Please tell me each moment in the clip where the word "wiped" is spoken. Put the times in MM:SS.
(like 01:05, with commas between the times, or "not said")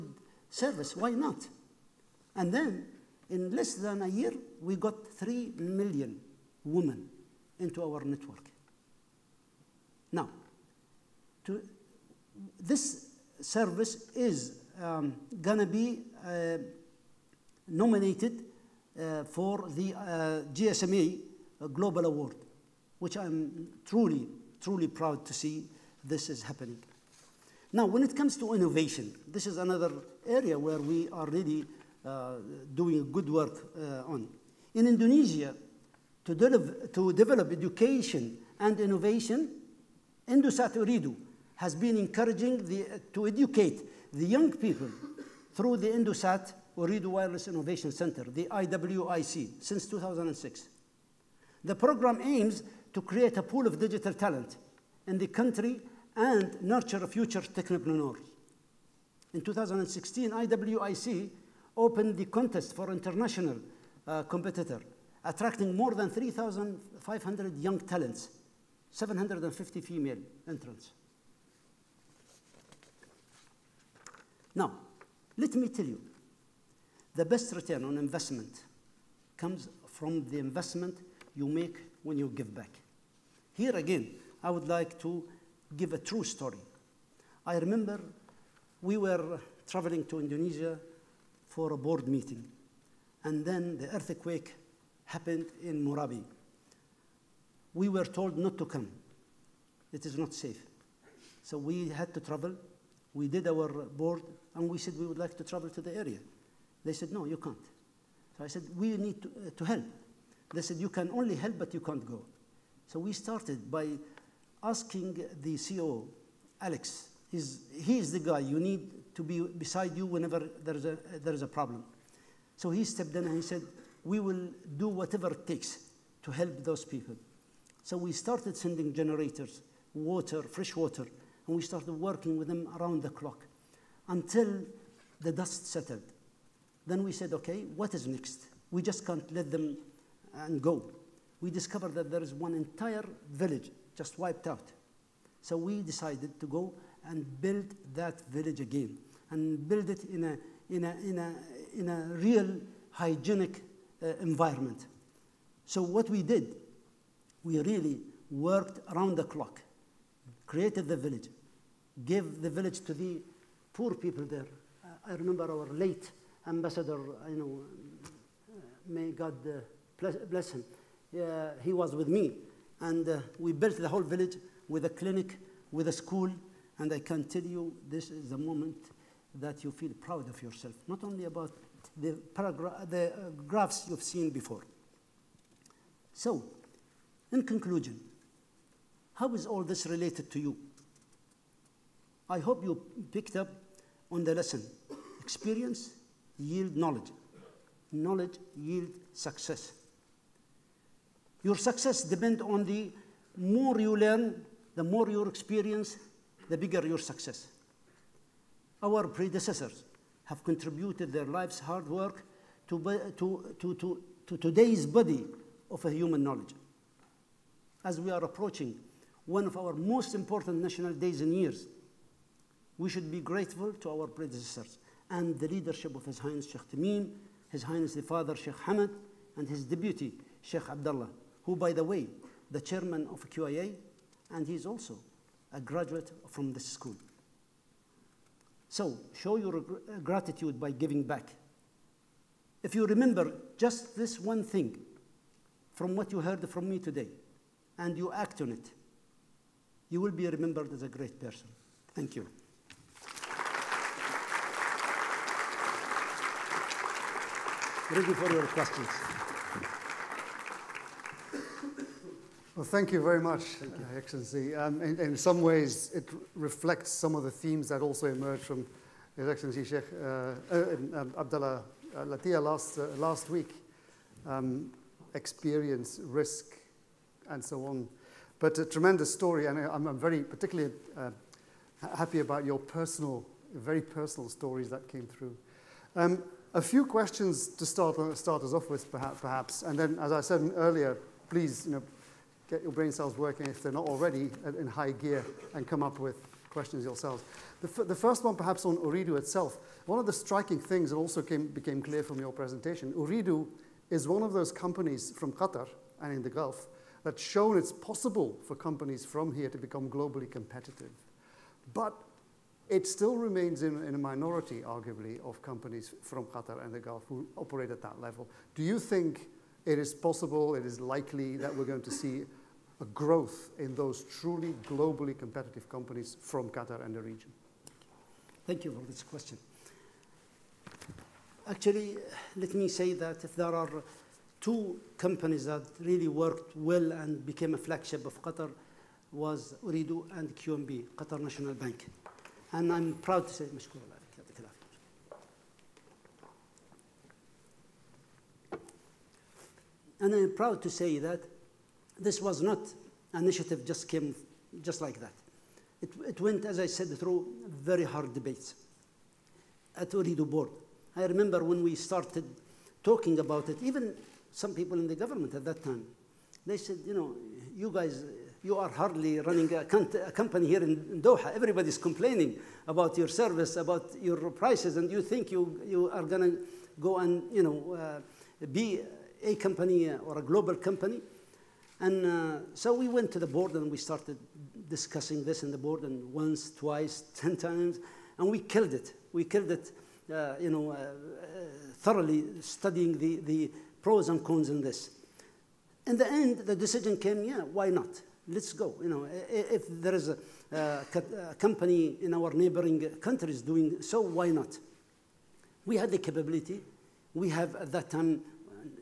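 02:24.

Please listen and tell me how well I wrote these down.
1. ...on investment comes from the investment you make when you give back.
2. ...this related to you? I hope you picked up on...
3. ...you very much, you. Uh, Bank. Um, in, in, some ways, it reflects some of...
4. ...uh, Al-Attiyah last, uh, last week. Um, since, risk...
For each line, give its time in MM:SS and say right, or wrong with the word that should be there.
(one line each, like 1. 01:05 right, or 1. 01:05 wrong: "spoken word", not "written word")
1. 01:17 right
2. 03:09 right
3. 04:22 wrong: "Excellency", not "Bank"
4. 04:31 wrong: "experience", not "since".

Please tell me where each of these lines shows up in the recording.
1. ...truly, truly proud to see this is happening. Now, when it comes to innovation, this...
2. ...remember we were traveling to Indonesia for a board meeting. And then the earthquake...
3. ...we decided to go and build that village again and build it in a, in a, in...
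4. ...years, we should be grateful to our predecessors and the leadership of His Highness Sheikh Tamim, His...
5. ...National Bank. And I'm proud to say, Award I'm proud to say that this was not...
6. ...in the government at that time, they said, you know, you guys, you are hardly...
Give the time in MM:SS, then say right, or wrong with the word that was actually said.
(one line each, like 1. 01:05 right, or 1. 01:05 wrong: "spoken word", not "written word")
1. 00:23 right
2. 01:27 right
3. 02:25 right
4. 03:41 right
5. 05:41 wrong: "And", not "Award"
6. 06:04 right.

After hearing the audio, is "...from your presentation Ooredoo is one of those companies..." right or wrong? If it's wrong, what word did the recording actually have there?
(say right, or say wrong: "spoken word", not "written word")
right.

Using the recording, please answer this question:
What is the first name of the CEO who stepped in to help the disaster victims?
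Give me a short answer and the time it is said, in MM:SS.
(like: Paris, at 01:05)
Alex, at 01:56.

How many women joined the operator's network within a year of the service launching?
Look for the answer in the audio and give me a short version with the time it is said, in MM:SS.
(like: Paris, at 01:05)
3 million, at 00:05.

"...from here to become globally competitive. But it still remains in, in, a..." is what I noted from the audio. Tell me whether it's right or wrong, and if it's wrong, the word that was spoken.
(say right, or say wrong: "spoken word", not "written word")
right.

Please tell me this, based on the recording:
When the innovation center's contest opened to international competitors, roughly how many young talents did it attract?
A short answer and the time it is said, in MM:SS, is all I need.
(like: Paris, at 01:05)
3,500, at 01:06.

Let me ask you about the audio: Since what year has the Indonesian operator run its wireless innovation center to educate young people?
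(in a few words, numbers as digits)
2006.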